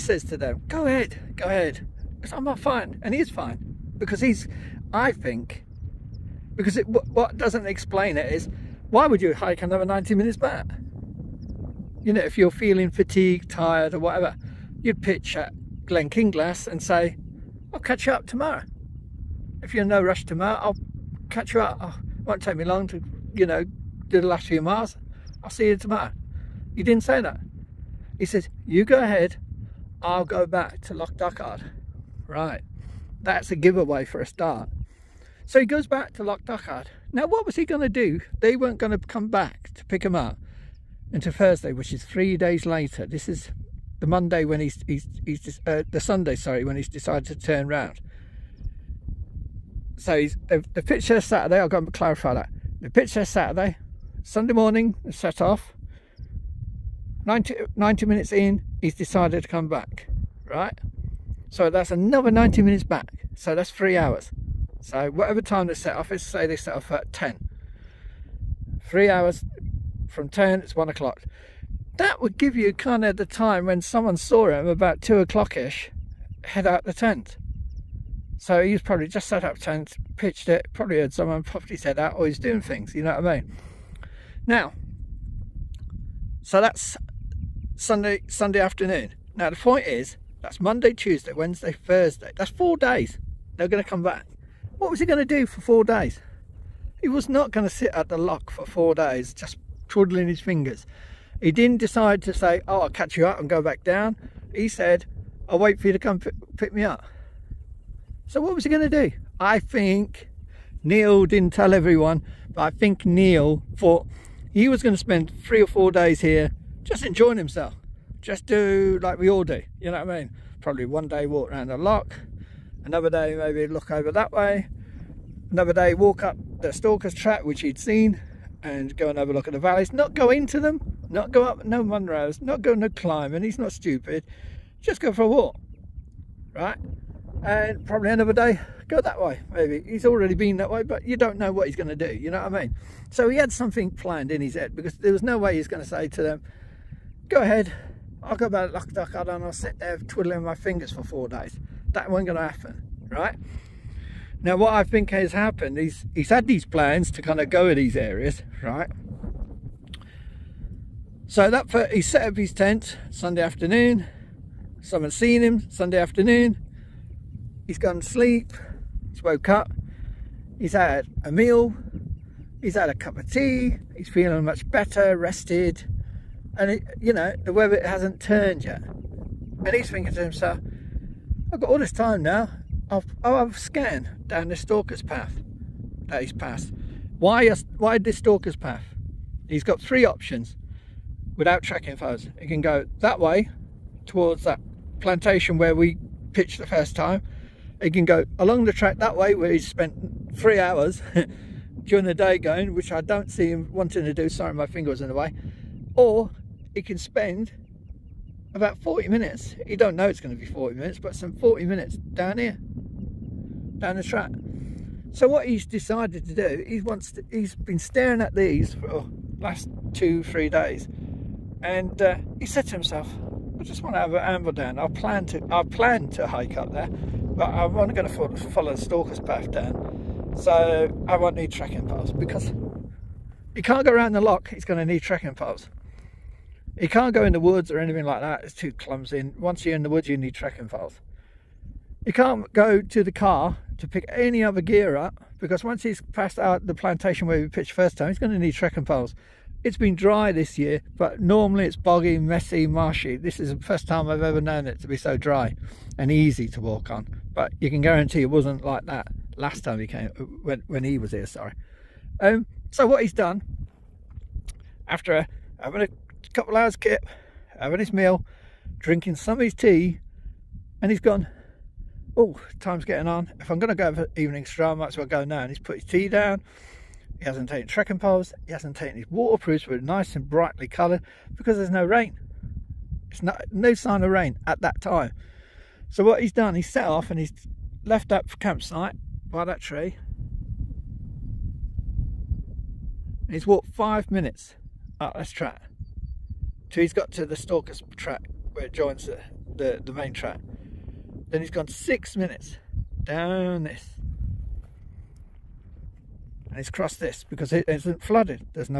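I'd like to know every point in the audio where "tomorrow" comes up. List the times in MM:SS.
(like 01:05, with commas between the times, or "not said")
00:18, 00:25.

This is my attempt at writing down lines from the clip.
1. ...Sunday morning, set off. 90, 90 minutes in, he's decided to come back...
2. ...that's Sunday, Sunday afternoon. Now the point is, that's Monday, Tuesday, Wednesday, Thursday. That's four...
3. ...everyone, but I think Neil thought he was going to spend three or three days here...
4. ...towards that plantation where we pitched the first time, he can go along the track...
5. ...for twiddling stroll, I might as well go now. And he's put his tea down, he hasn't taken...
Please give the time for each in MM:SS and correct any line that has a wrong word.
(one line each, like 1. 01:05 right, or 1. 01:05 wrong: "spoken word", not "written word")
1. 00:54 right
2. 01:26 right
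3. 01:51 wrong: "four", not "three"
4. 03:14 right
5. 04:33 wrong: "evening", not "twiddling".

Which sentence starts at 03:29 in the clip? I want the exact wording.
He don't know it's going to be 40 minutes, but some 40 minutes down here, down the track.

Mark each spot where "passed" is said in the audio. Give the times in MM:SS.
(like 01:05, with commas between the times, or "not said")
03:06, 04:06.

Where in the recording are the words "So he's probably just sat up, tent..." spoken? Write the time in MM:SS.
01:18.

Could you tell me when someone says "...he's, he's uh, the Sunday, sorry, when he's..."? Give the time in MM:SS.
00:44.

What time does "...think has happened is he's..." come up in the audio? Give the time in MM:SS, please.
02:34.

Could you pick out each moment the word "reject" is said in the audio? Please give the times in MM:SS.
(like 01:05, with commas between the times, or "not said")
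not said.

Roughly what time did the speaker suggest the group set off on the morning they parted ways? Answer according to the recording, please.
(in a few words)
10.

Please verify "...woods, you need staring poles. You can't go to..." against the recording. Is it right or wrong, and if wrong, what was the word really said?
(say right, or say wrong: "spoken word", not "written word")
wrong: "trekking", not "staring".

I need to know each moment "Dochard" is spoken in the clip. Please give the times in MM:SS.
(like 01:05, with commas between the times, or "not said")
00:31, 00:36, 02:28.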